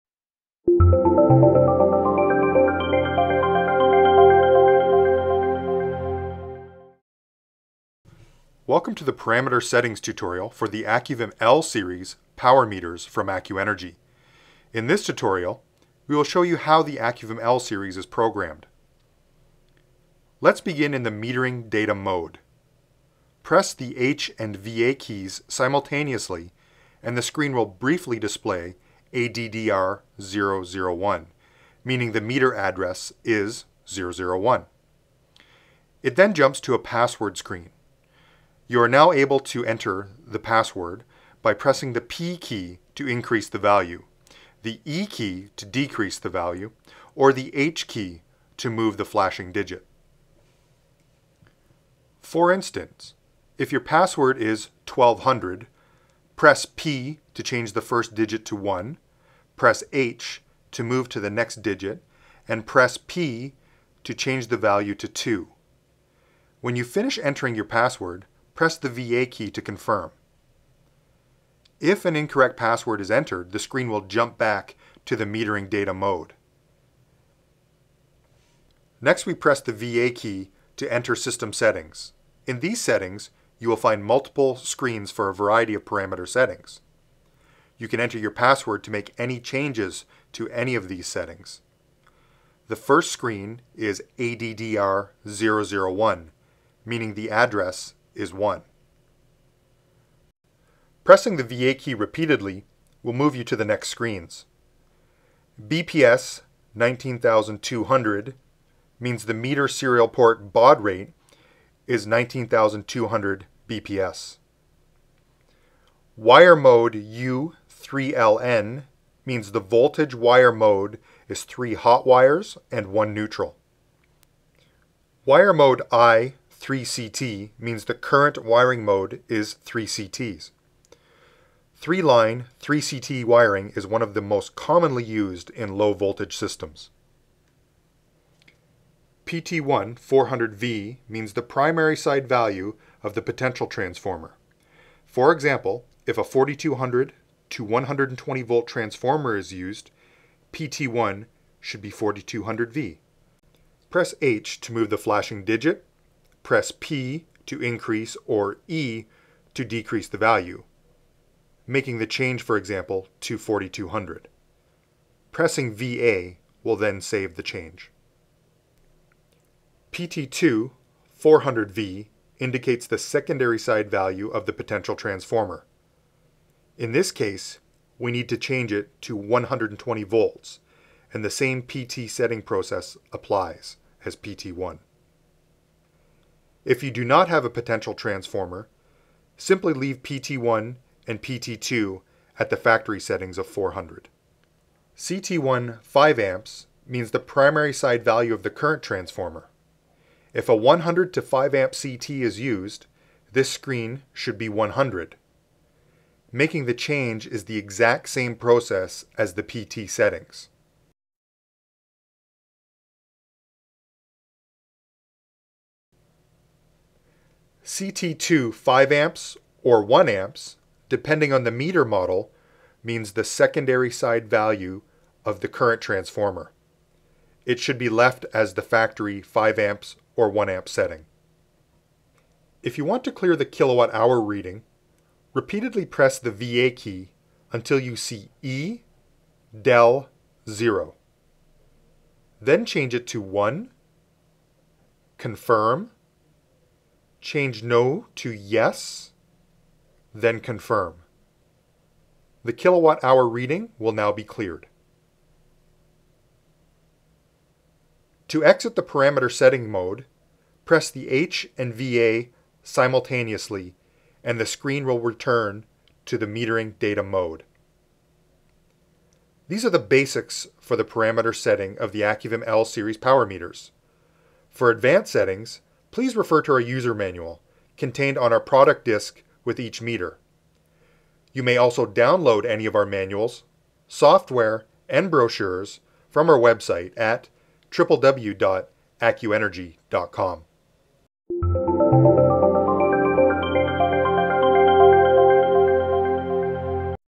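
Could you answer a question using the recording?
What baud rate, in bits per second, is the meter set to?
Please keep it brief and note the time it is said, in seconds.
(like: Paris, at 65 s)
19200, at 112 s.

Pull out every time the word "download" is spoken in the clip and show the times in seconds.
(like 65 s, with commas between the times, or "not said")
281 s.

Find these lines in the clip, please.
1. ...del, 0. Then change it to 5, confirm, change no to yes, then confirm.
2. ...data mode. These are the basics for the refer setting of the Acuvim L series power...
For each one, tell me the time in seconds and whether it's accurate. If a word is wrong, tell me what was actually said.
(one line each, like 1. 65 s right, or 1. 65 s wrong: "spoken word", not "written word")
1. 239 s wrong: "1", not "5"
2. 266 s wrong: "parameter", not "refer".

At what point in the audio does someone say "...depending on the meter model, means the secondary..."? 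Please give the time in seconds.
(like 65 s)
220 s.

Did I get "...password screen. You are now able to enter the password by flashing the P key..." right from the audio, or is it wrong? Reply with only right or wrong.
wrong.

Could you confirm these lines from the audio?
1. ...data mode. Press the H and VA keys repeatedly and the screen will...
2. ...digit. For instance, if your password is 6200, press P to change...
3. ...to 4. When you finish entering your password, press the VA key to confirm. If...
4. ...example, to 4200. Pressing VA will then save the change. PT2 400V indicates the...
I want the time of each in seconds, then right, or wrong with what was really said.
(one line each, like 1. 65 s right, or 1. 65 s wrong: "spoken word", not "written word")
1. 21 s wrong: "simultaneously", not "repeatedly"
2. 49 s wrong: "1200", not "6200"
3. 64 s wrong: "2", not "4"
4. 162 s right.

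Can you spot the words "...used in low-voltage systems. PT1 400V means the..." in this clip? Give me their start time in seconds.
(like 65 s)
135 s.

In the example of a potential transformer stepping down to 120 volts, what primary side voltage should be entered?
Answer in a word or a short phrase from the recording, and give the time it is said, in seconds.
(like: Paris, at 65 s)
4200V, at 150 s.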